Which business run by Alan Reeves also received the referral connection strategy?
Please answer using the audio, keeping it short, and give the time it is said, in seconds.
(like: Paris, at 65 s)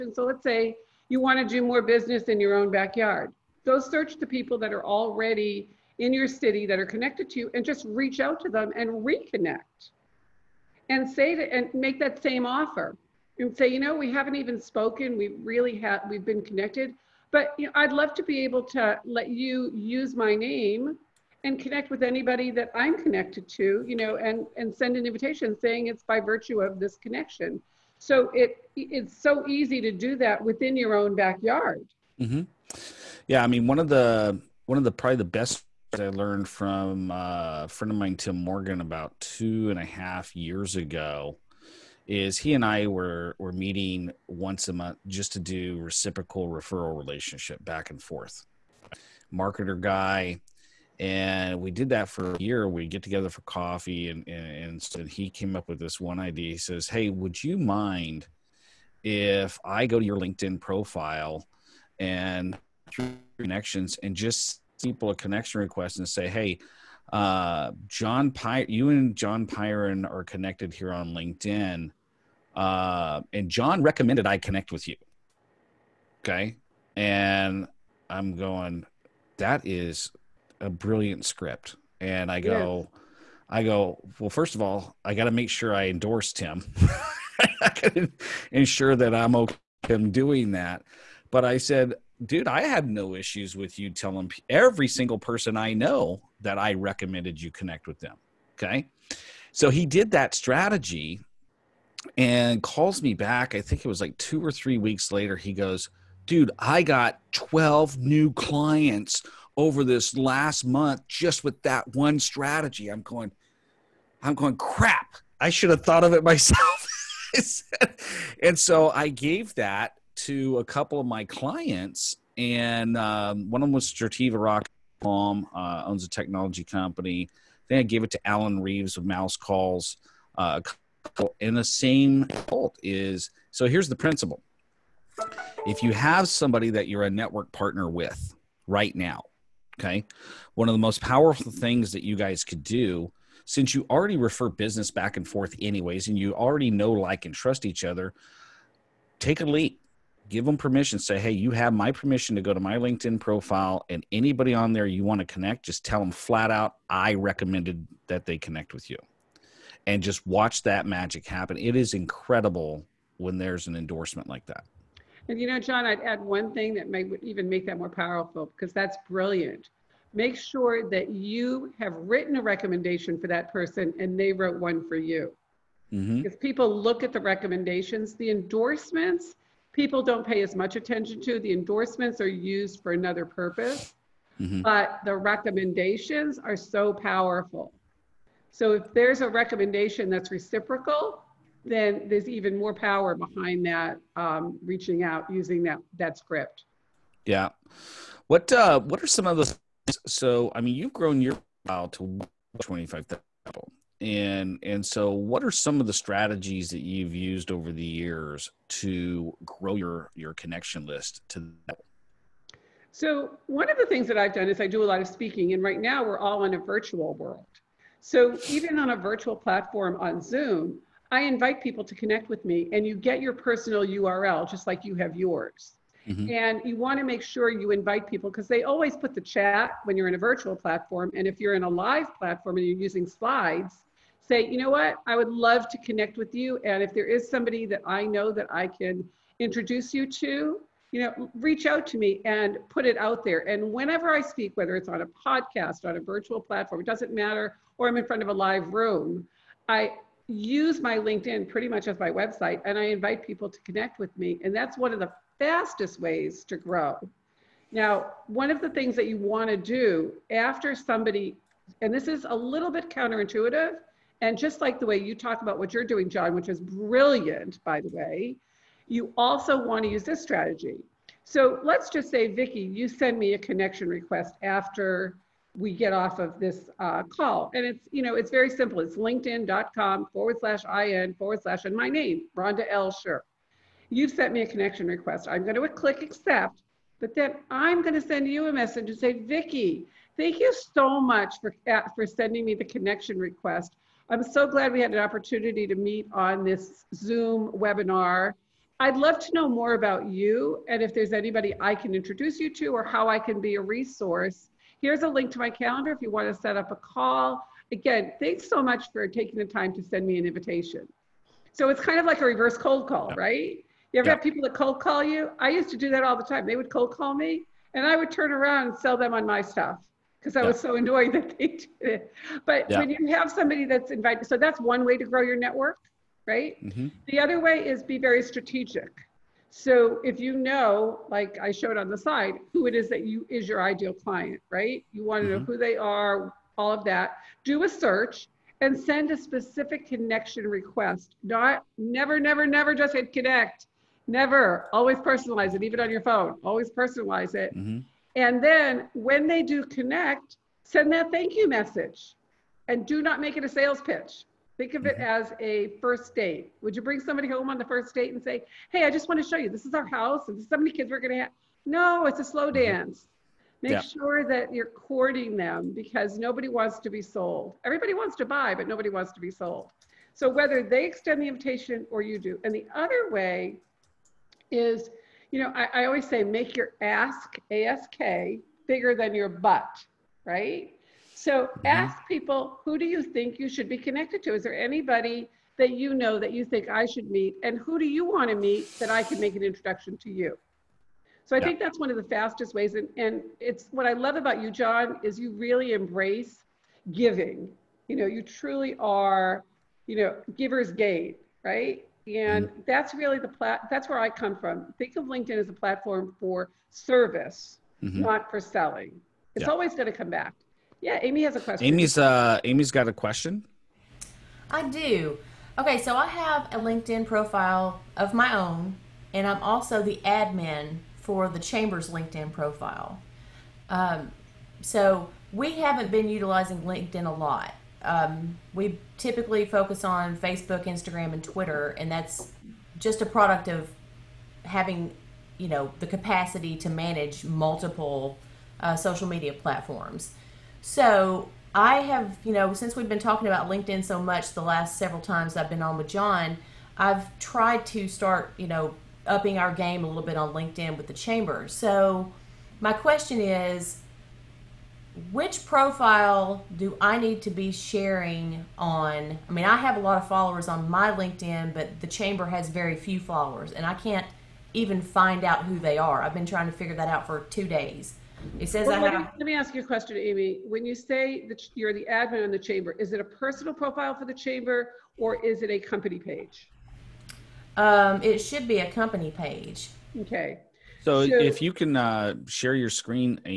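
Mouse Calls, at 129 s.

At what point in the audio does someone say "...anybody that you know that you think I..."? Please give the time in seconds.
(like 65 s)
384 s.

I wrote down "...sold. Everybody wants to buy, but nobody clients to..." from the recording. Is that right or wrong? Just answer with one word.
wrong.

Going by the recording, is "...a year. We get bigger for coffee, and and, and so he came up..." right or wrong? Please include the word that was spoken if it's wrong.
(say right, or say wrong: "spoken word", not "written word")
wrong: "together", not "bigger".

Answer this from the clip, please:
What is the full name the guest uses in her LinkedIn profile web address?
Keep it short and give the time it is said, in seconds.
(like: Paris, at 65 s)
Rhonda L. Sher, at 282 s.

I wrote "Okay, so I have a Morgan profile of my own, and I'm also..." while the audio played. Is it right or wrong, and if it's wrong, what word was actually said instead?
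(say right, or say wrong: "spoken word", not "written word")
wrong: "LinkedIn", not "Morgan".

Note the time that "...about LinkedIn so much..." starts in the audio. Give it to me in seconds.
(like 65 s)
443 s.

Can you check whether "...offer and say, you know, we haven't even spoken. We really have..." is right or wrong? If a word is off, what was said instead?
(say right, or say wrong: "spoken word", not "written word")
right.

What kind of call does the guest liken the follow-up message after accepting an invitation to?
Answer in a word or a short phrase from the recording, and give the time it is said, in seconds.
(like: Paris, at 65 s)
reverse cold call, at 312 s.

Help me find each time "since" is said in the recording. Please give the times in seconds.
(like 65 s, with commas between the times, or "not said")
143 s, 442 s.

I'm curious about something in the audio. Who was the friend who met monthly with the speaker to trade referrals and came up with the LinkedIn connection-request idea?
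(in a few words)
Tim Morgan.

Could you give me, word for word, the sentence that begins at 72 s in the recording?
Uh, and John recommended I connect with you.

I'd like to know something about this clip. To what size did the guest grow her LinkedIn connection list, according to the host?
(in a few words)
25,000.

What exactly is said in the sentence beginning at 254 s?
And that's one of the fastest ways to grow.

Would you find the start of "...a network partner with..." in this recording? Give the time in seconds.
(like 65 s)
137 s.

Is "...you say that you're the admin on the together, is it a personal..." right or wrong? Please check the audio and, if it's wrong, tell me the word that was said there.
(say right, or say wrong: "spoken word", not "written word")
wrong: "chamber", not "together".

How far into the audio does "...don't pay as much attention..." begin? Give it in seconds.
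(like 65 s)
180 s.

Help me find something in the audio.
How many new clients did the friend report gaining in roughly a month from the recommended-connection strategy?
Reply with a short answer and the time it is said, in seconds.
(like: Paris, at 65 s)
12, at 107 s.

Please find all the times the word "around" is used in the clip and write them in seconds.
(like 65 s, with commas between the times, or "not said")
318 s.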